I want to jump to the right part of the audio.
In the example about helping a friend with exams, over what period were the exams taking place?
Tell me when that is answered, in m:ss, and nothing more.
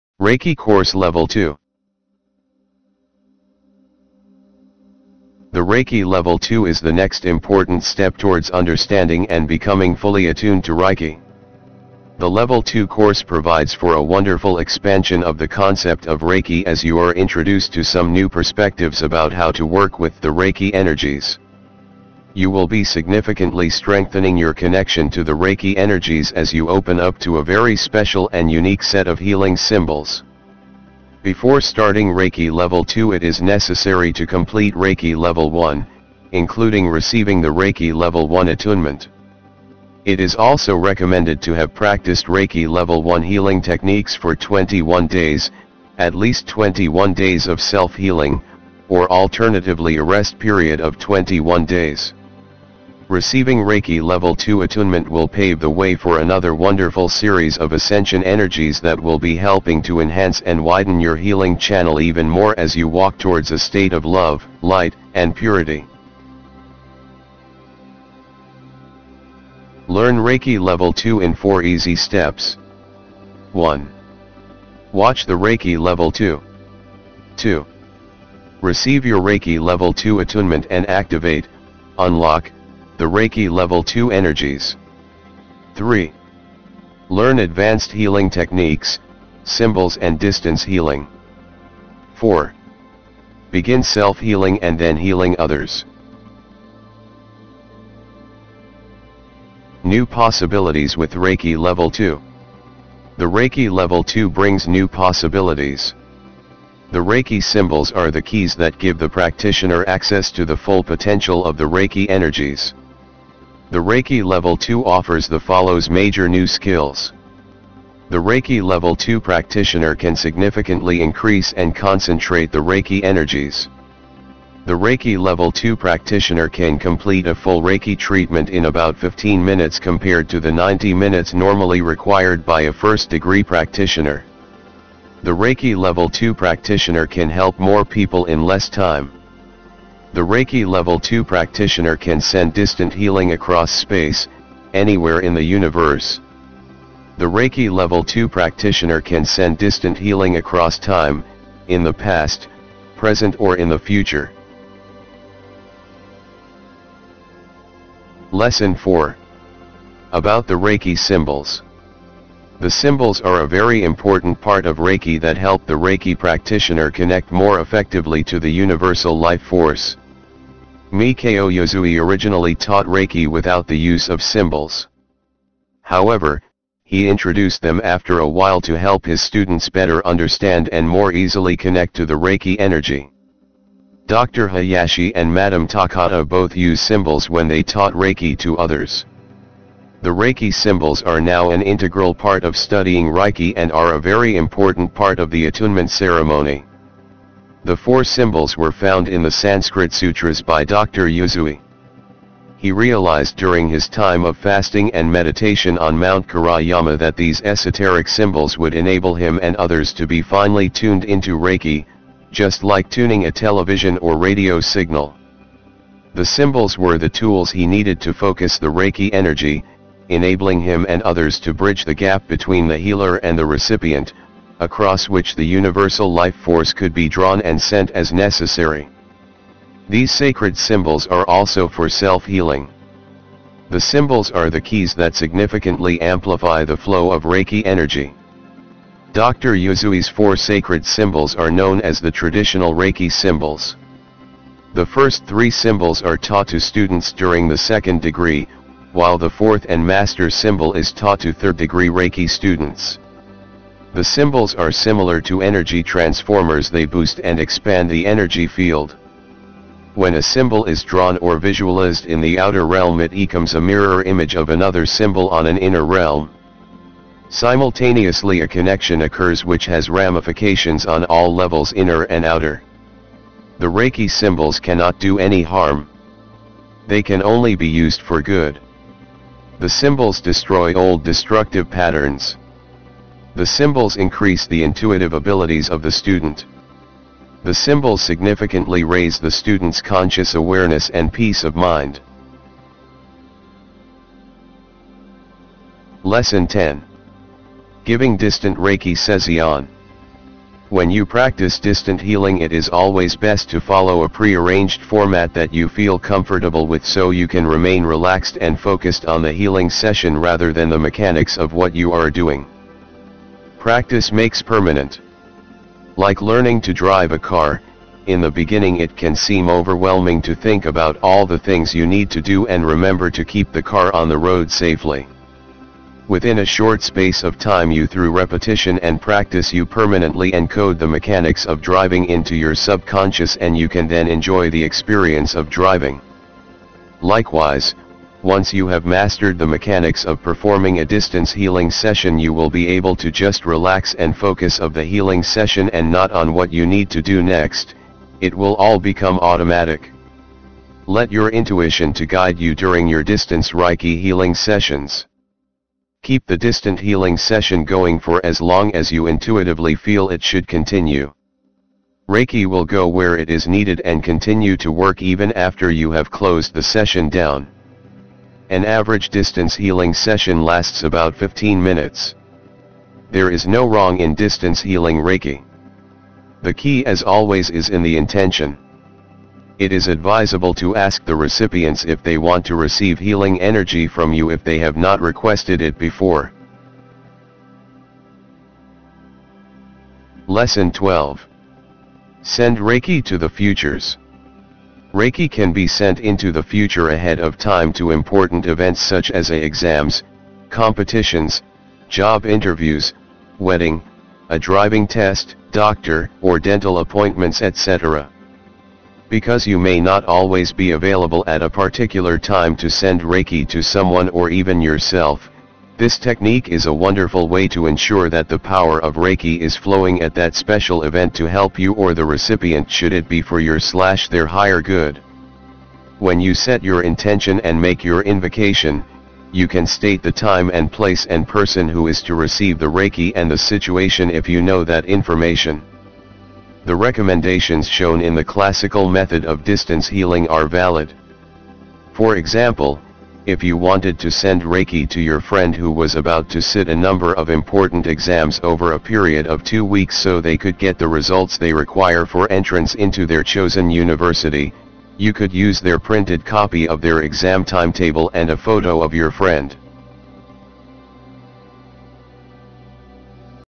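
7:29.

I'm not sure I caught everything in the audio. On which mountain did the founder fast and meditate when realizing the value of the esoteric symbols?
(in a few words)
Mount Karayama.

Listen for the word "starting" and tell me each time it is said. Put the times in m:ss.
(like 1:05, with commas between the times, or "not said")
0:31.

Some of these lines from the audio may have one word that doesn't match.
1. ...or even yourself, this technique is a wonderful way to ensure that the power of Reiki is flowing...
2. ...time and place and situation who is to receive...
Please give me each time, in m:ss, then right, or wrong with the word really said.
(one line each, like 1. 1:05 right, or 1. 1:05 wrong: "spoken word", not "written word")
1. 6:54 right
2. 7:10 wrong: "person", not "situation".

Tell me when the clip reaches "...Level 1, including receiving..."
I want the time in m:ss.
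0:35.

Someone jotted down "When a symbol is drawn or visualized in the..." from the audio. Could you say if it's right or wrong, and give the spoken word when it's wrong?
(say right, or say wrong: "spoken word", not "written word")
right.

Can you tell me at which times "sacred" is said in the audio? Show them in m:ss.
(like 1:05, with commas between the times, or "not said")
3:50, 4:00.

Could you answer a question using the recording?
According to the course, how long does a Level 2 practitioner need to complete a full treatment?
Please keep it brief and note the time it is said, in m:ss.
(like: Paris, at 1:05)
15 minutes, at 2:08.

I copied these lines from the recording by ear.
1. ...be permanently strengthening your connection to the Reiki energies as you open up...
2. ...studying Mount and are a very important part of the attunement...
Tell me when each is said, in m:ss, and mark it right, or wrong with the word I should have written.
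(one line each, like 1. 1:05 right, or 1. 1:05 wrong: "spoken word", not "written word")
1. 0:22 wrong: "significantly", not "permanently"
2. 3:12 wrong: "Reiki", not "Mount".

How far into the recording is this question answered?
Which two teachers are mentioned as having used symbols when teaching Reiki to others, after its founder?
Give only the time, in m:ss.
3:04.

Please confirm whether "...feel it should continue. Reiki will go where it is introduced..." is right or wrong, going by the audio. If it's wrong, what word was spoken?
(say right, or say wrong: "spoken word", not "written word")
wrong: "needed", not "introduced".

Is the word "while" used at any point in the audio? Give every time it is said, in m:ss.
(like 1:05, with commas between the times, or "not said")
2:58, 4:08.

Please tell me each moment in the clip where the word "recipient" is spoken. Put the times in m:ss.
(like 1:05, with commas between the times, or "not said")
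3:43, 6:21, 7:02.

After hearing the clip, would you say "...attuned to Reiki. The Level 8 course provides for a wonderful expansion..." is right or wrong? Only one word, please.
wrong.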